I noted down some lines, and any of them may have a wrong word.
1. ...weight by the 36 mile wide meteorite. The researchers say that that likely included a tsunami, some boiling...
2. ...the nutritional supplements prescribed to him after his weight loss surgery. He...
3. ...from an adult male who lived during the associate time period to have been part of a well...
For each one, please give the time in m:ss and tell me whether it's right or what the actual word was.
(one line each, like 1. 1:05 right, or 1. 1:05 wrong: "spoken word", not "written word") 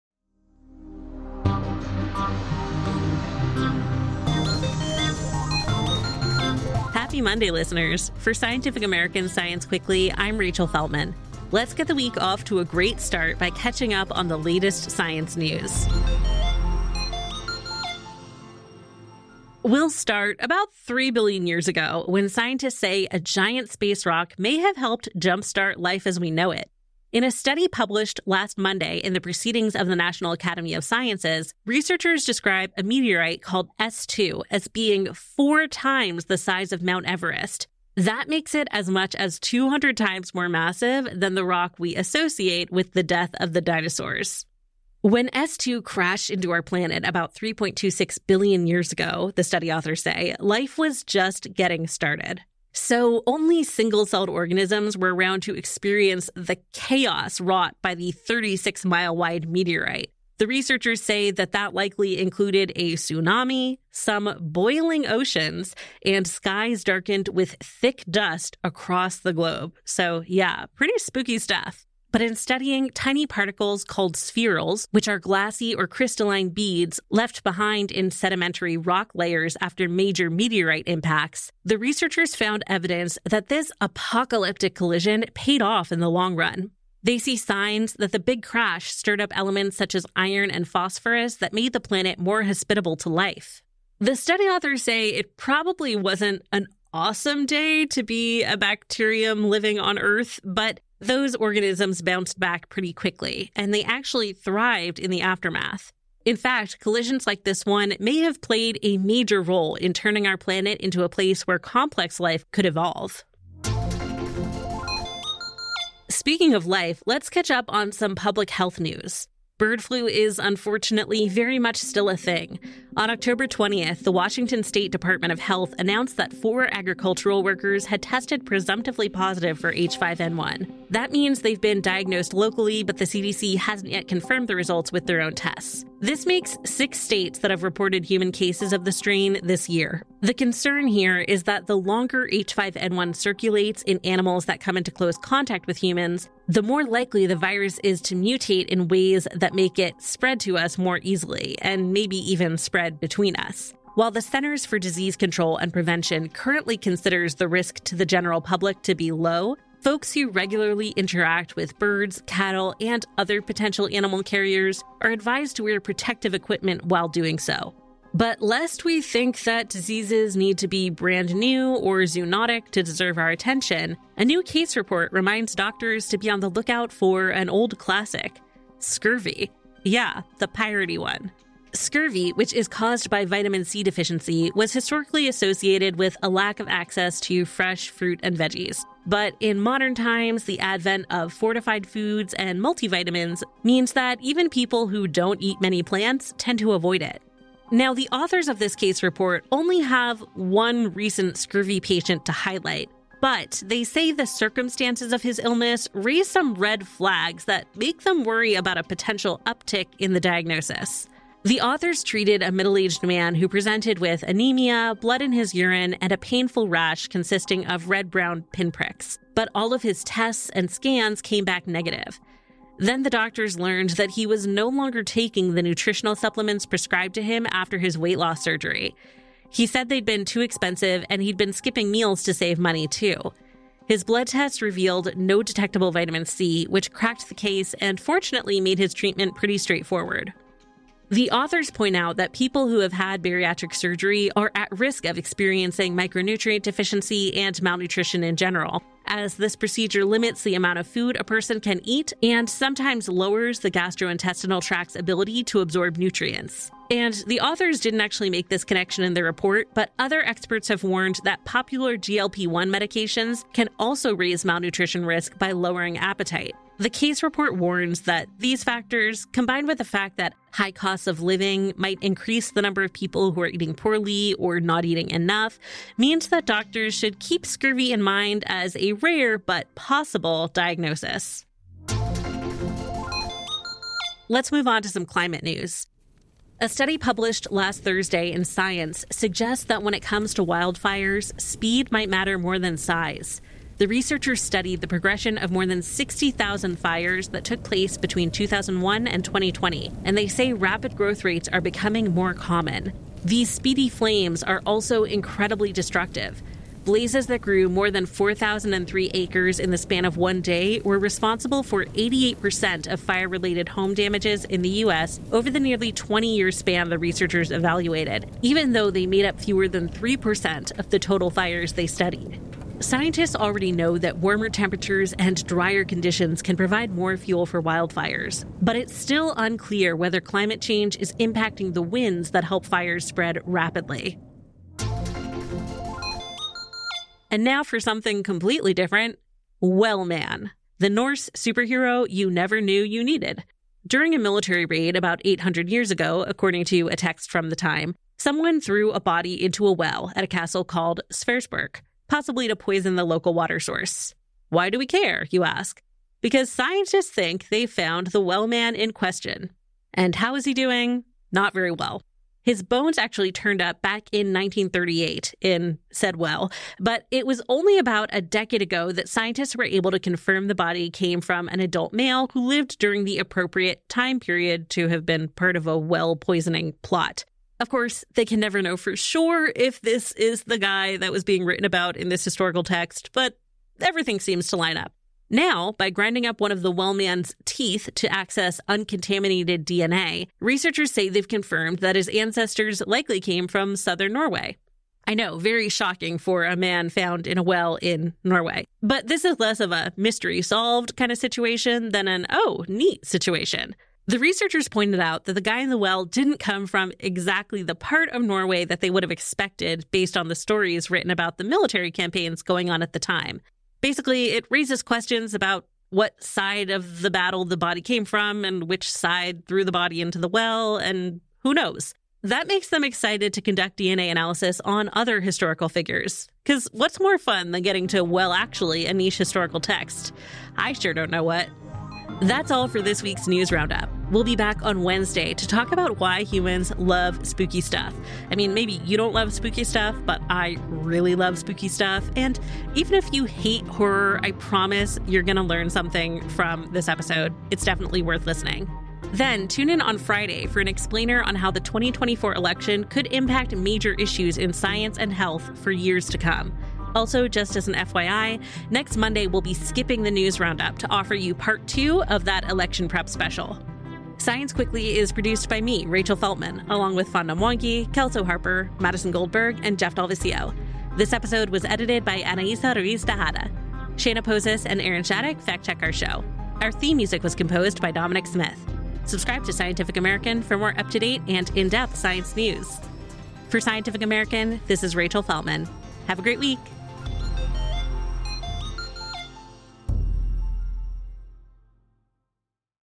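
1. 0:57 wrong: "wrought", not "weight"
2. 3:45 right
3. 6:11 wrong: "appropriate", not "associate".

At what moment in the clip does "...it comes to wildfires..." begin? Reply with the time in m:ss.
4:49.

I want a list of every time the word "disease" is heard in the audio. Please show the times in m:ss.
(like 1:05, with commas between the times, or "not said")
2:34, 2:49.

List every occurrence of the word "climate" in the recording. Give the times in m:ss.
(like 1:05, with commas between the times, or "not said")
4:45, 5:30.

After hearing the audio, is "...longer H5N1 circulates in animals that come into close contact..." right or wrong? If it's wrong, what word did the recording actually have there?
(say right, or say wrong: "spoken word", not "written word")
right.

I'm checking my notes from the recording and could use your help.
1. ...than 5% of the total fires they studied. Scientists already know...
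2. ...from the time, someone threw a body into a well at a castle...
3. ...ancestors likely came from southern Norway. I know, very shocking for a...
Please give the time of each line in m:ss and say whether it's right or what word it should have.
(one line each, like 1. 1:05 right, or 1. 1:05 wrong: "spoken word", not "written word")
1. 5:19 wrong: "3", not "5"
2. 5:47 right
3. 6:32 right.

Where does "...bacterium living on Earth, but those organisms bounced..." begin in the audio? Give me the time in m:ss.
1:38.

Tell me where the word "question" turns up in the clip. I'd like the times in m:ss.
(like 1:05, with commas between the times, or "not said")
5:58, 6:54.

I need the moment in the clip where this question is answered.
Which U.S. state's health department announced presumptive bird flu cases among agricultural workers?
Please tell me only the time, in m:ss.
2:04.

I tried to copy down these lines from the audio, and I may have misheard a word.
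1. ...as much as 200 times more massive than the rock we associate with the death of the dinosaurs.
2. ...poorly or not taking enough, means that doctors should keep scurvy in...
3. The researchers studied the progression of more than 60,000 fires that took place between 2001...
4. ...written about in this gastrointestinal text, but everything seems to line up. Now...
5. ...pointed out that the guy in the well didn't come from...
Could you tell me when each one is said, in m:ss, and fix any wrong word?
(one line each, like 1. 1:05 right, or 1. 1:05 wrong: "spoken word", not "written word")
1. 0:38 right
2. 4:33 wrong: "eating", not "taking"
3. 4:53 right
4. 6:21 wrong: "historical", not "gastrointestinal"
5. 6:44 right.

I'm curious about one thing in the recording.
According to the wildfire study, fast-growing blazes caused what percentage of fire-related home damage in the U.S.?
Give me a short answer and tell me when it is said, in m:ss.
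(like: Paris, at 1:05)
88%, at 5:11.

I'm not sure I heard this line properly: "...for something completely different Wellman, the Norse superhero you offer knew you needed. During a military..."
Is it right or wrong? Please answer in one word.
wrong.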